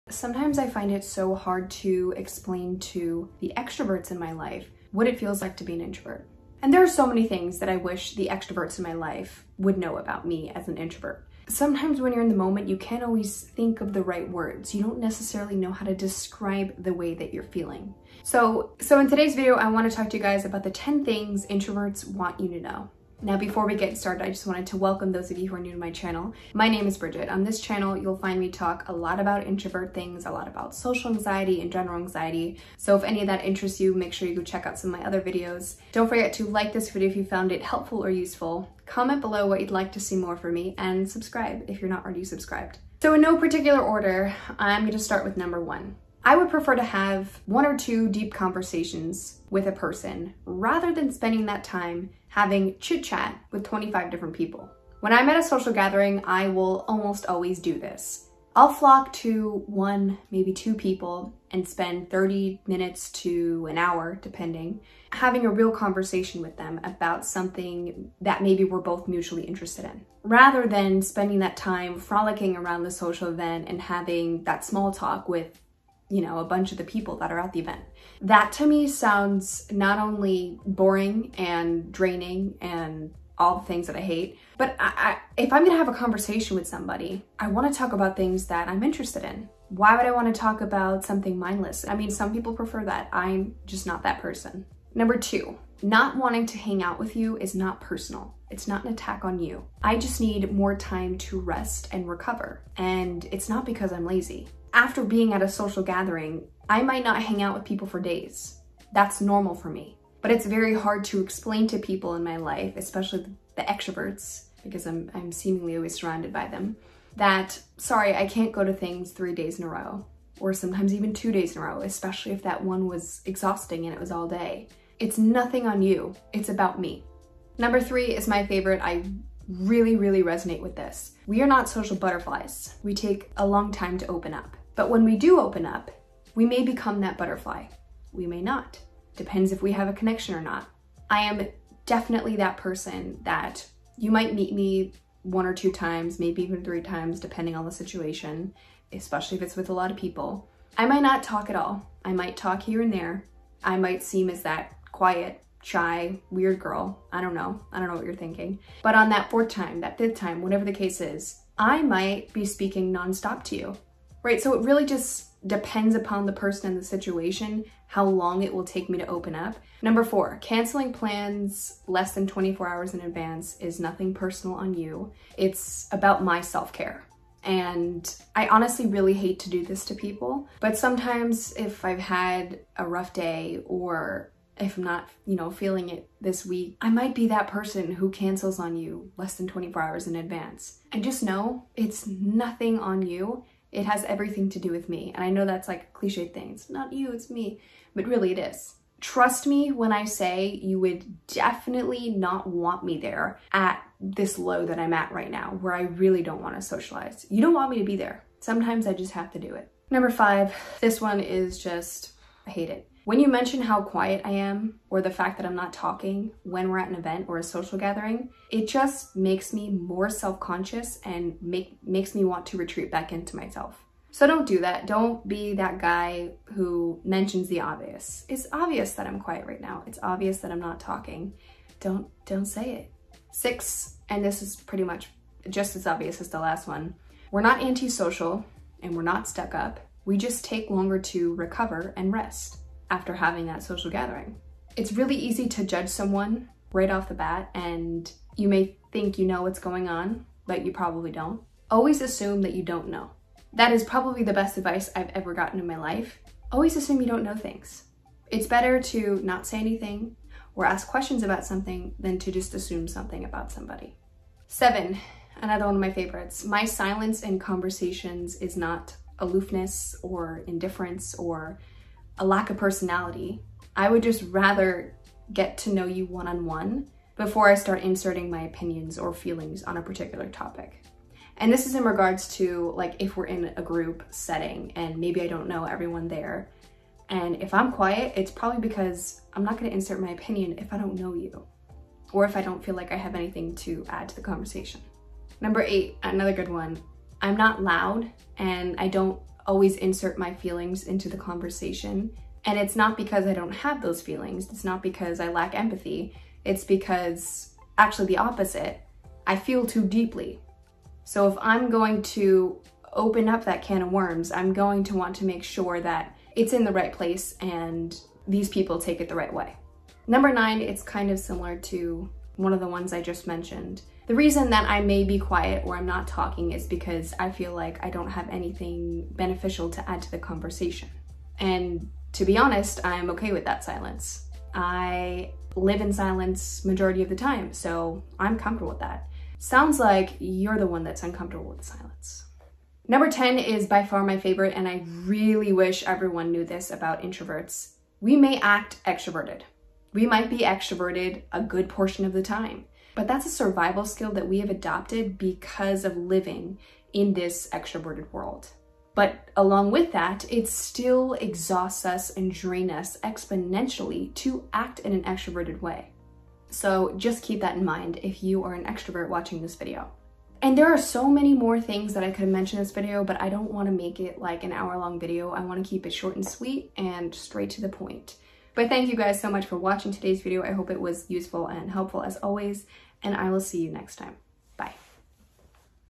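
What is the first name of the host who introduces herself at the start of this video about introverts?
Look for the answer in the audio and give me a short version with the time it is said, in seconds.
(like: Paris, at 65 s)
Bridget, at 26 s.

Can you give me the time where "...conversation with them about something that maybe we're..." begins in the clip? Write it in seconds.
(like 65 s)
65 s.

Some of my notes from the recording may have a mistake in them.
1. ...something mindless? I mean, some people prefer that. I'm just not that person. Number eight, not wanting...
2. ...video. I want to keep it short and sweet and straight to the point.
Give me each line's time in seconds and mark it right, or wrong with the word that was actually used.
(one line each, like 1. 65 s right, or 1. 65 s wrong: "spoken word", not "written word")
1. 91 s wrong: "two", not "eight"
2. 374 s right.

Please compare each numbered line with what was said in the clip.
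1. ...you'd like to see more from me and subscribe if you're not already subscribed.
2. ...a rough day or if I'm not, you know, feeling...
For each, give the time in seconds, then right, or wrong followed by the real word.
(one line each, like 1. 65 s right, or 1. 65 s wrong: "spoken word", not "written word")
1. 39 s right
2. 182 s right.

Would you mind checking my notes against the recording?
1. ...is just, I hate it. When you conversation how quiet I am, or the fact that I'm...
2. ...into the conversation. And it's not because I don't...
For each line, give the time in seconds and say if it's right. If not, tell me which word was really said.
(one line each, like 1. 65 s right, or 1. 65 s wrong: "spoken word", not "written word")
1. 211 s wrong: "mention", not "conversation"
2. 300 s right.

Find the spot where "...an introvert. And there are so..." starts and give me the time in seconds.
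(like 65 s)
5 s.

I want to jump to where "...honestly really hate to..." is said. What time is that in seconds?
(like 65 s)
178 s.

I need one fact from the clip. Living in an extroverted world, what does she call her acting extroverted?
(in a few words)
a survival skill.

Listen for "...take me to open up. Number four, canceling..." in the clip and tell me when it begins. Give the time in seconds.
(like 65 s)
168 s.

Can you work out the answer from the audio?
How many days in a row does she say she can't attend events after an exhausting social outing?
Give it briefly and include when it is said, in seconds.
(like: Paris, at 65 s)
3, at 119 s.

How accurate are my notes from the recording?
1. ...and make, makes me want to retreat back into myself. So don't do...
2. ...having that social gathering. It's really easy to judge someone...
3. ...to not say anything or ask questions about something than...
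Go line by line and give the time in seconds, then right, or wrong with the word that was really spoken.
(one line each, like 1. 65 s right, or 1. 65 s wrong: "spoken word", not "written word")
1. 221 s right
2. 243 s right
3. 258 s right.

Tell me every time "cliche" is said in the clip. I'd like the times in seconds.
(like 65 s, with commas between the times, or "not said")
195 s.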